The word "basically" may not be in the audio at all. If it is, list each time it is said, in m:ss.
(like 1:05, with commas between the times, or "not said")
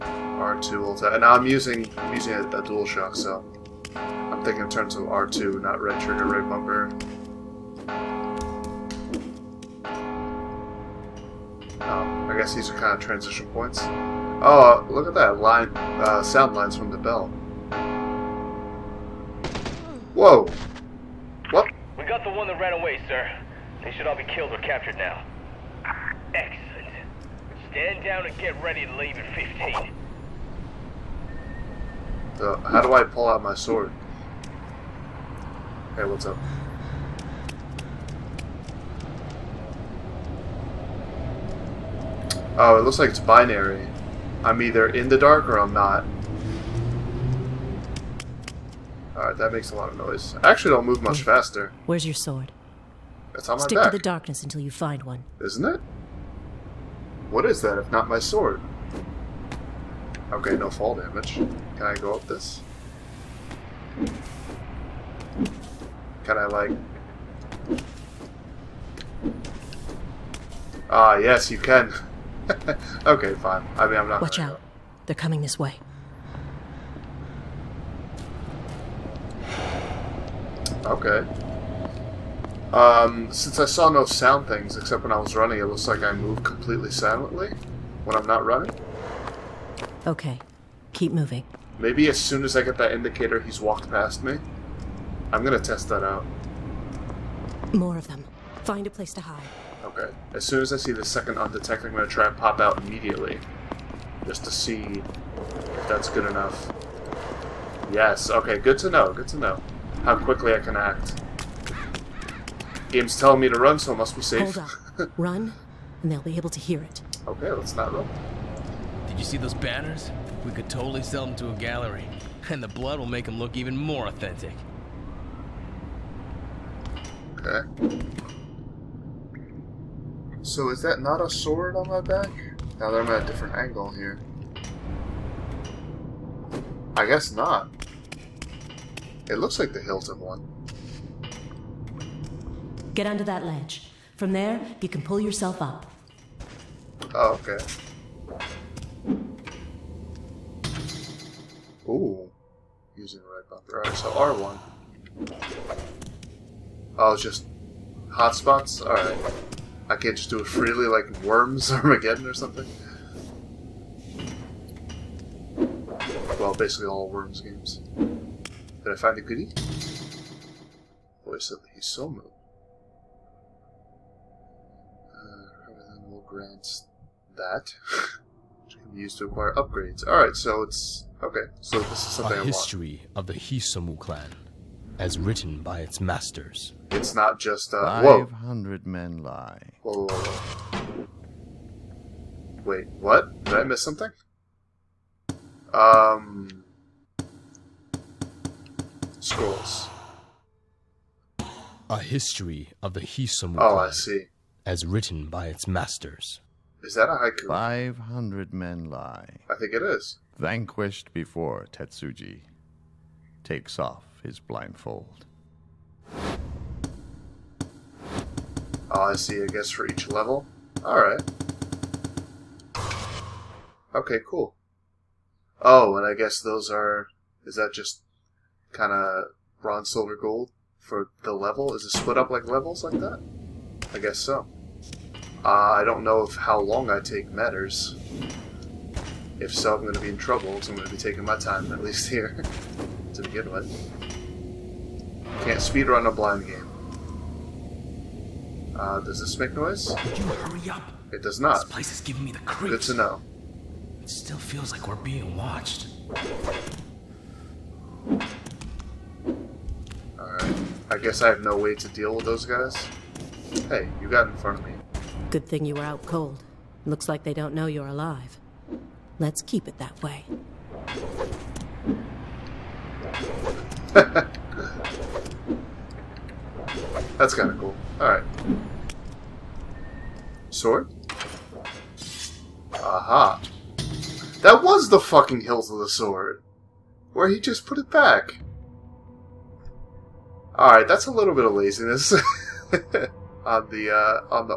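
2:46.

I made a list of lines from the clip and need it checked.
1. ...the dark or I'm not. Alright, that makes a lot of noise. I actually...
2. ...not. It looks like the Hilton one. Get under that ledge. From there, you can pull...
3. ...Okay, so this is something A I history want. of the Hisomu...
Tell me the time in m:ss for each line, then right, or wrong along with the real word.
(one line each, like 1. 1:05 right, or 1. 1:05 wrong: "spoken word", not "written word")
1. 0:45 right
2. 2:17 right
3. 3:01 right.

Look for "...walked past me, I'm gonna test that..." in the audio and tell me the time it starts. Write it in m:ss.
1:33.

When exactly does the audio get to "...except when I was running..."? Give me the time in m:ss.
1:24.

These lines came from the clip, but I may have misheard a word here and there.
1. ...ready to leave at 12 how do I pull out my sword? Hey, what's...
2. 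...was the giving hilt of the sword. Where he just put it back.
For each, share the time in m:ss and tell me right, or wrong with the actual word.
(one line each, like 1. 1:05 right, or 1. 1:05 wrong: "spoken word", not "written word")
1. 0:28 wrong: "15", not "12"
2. 4:44 wrong: "fucking", not "giving".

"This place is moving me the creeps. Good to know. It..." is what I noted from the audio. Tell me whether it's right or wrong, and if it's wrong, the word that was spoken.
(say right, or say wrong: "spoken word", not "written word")
wrong: "giving", not "moving".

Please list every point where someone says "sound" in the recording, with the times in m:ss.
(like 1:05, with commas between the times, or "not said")
0:16, 1:24.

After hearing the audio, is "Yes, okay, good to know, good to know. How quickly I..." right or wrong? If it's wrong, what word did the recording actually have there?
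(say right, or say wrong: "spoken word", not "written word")
right.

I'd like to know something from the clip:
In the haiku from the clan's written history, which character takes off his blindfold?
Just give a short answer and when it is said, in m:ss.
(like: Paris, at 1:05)
Tetsuji, at 3:31.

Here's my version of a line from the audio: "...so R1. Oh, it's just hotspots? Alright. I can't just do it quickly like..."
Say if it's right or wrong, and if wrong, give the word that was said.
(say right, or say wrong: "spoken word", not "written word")
wrong: "freely", not "quickly".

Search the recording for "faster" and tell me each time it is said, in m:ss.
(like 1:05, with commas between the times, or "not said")
0:51.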